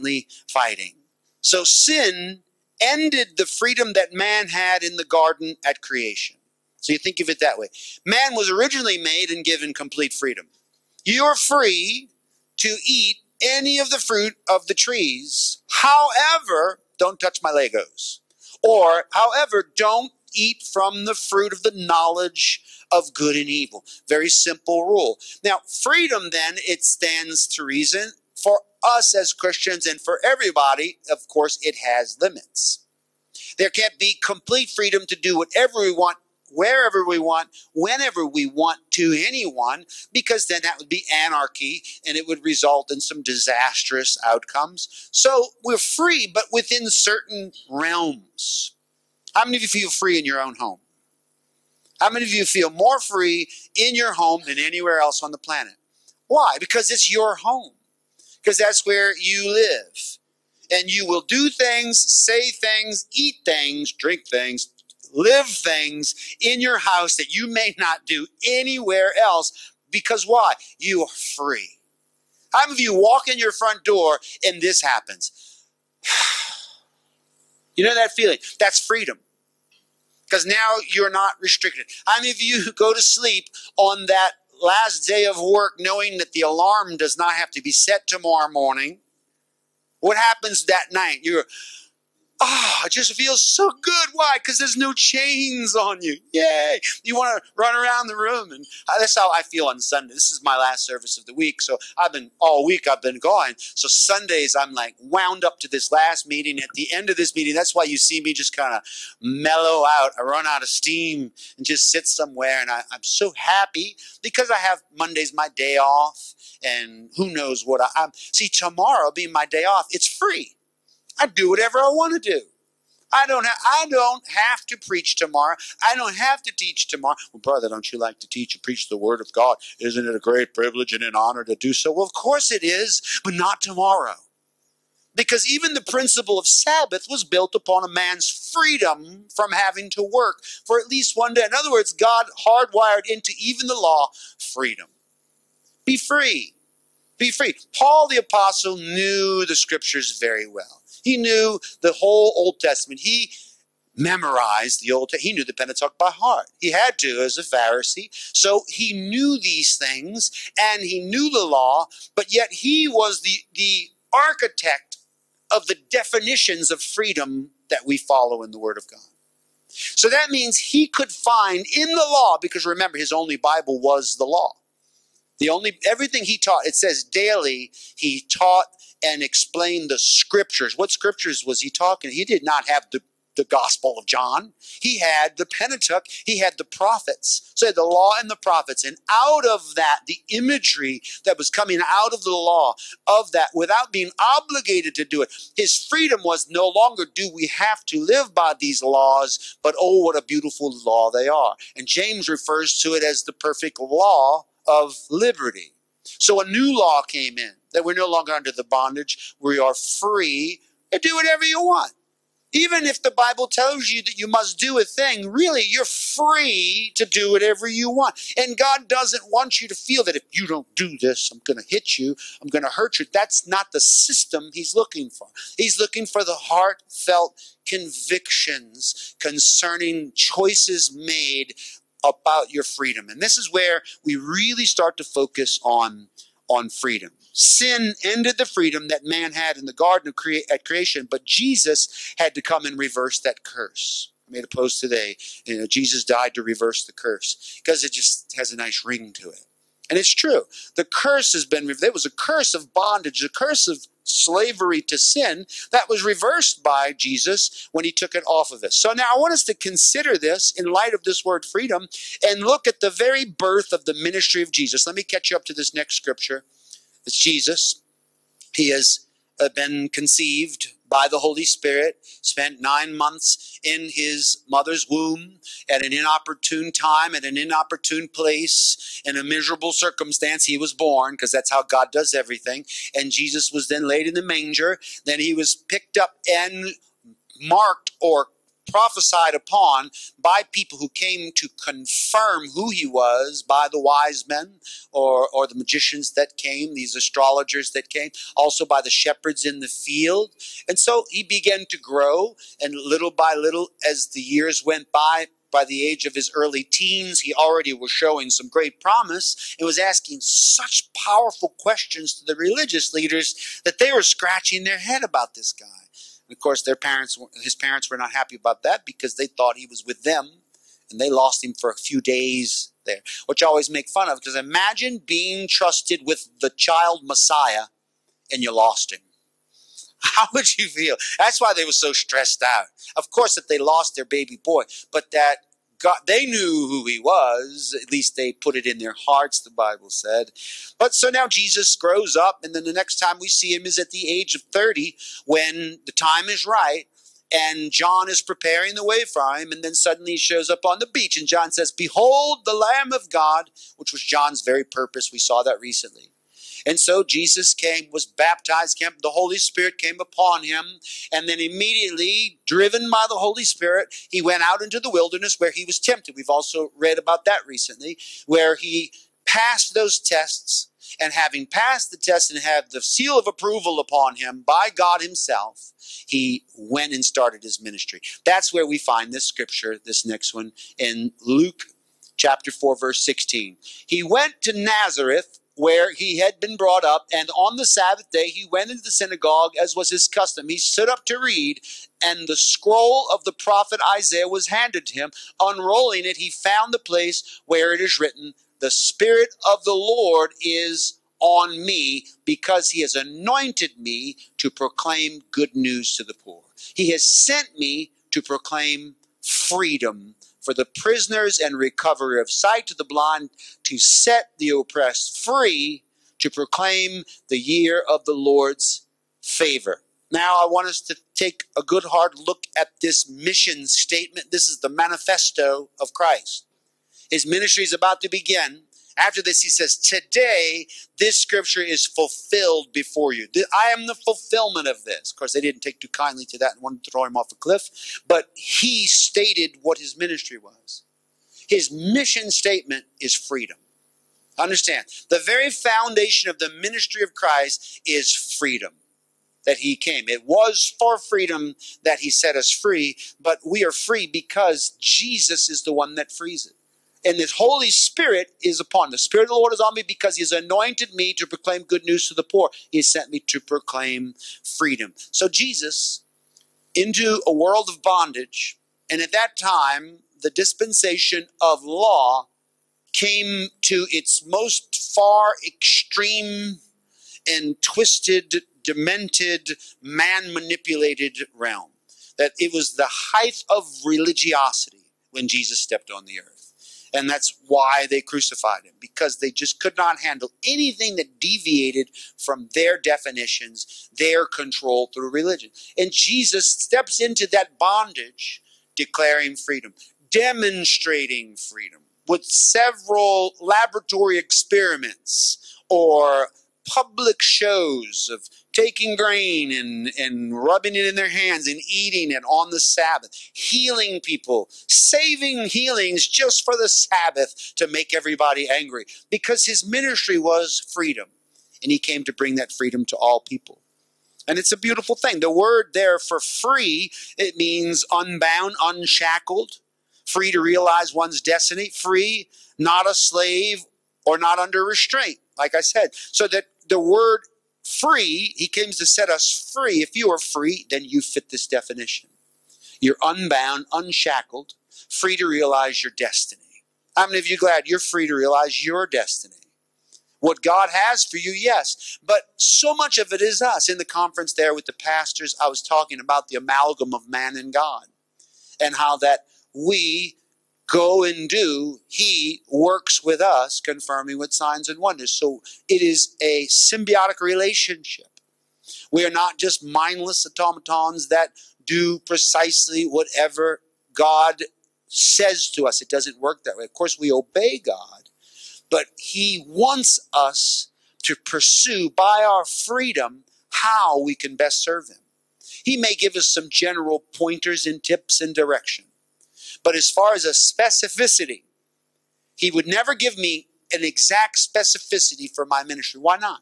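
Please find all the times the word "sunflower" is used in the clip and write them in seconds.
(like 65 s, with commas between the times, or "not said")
not said.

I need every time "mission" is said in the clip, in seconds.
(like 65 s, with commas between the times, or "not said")
423 s, 441 s.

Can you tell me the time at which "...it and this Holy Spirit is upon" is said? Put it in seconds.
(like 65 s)
456 s.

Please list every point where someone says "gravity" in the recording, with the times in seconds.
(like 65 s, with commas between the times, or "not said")
not said.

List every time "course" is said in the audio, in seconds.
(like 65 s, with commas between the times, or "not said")
31 s, 132 s, 316 s, 333 s, 435 s, 576 s.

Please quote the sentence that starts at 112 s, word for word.
And I, am so happy because I have Mondays my day off.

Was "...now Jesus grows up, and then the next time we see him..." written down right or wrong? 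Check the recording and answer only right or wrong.
right.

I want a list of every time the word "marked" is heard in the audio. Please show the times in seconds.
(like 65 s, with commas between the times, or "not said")
287 s.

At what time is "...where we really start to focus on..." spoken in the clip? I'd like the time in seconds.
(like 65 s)
233 s.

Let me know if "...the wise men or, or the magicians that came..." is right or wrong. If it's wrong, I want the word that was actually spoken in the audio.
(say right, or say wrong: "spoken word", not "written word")
right.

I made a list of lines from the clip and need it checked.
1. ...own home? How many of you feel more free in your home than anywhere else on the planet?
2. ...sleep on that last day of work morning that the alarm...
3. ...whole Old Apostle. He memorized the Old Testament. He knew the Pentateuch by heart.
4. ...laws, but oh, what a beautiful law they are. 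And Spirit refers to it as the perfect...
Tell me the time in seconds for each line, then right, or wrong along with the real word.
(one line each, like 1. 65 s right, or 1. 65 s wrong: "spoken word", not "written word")
1. 50 s right
2. 83 s wrong: "knowing", not "morning"
3. 151 s wrong: "Testament", not "Apostle"
4. 198 s wrong: "James", not "Spirit".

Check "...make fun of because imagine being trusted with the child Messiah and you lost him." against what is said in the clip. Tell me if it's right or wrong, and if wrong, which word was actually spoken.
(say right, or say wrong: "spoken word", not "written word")
right.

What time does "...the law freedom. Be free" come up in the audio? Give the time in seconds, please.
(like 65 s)
143 s.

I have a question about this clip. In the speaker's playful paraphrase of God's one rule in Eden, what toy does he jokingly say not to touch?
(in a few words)
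Legos.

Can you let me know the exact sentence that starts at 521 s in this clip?
And he came to bring that freedom to all people.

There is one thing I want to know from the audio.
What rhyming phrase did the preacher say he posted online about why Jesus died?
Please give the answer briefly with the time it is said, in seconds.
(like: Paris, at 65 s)
reverse the curse, at 246 s.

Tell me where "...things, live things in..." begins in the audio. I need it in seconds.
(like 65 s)
64 s.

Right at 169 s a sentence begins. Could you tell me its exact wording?
So that means he could find in the law, because remember, his only Bible was the law.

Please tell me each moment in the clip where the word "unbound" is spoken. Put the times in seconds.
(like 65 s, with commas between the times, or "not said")
527 s, 543 s.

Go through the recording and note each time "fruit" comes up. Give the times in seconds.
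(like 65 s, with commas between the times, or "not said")
13 s, 21 s.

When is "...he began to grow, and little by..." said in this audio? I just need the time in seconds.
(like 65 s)
301 s.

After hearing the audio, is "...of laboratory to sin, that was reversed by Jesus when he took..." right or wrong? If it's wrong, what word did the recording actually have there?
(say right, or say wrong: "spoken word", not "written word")
wrong: "slavery", not "laboratory".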